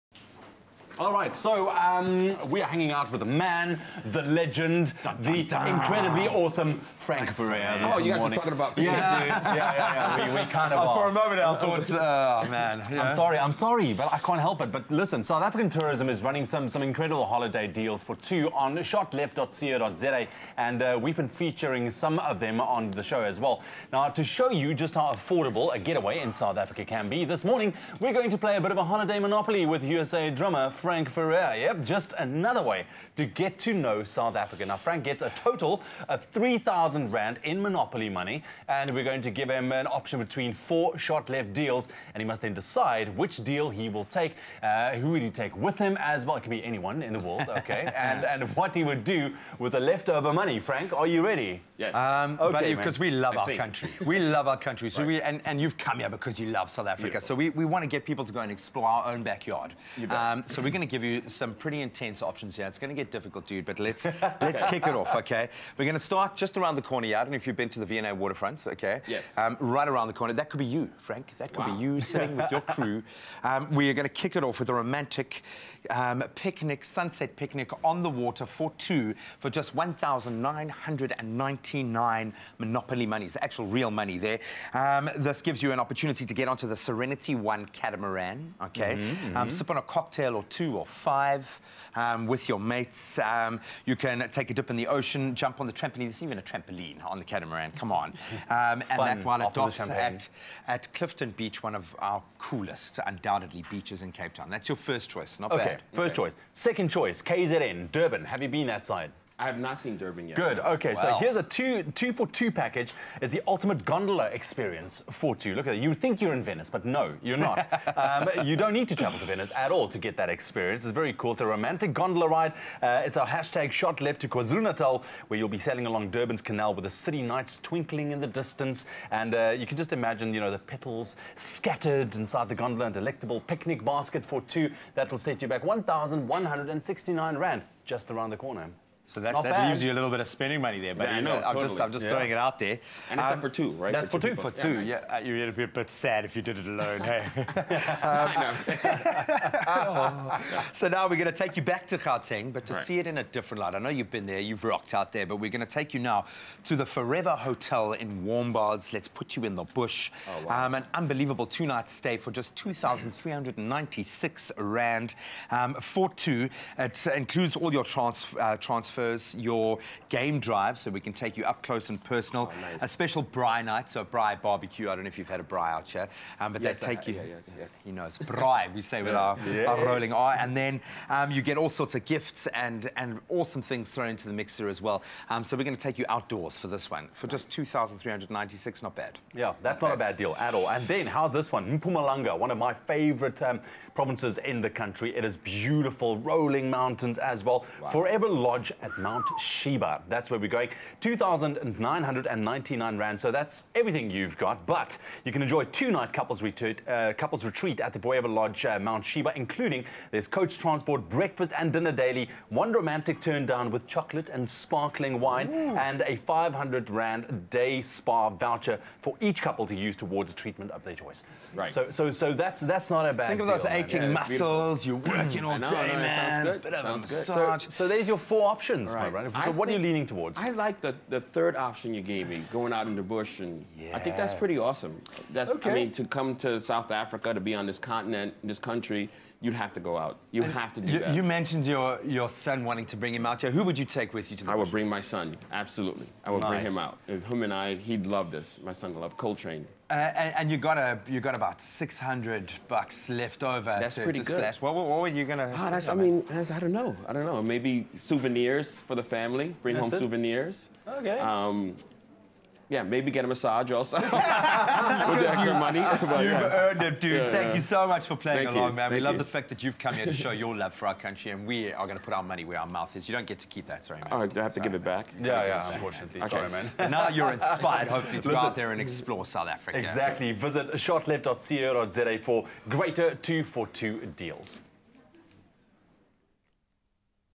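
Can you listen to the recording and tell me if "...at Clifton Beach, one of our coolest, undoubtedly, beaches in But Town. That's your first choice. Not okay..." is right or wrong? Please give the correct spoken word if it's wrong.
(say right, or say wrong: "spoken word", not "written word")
wrong: "Cape", not "But".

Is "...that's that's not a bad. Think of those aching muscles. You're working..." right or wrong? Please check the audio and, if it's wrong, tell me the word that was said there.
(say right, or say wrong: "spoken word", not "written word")
right.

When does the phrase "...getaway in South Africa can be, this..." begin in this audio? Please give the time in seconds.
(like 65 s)
25 s.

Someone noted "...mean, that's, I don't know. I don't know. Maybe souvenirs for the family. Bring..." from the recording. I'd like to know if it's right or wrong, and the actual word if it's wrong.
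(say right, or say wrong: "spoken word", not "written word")
right.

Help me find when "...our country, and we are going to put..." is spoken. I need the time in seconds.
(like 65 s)
270 s.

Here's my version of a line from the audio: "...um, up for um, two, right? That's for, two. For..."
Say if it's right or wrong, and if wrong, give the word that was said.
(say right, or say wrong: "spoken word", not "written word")
right.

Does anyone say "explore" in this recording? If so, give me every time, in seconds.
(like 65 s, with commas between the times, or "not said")
58 s, 278 s.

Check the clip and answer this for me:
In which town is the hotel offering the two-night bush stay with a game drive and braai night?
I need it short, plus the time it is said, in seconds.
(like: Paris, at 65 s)
Warmbaths, at 158 s.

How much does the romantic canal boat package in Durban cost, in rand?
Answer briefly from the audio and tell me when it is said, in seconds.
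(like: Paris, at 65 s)
1,169, at 135 s.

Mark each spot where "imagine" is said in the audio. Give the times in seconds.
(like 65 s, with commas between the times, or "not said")
129 s.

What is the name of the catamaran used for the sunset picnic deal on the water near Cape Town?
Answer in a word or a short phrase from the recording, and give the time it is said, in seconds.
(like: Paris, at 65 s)
Serenity One, at 86 s.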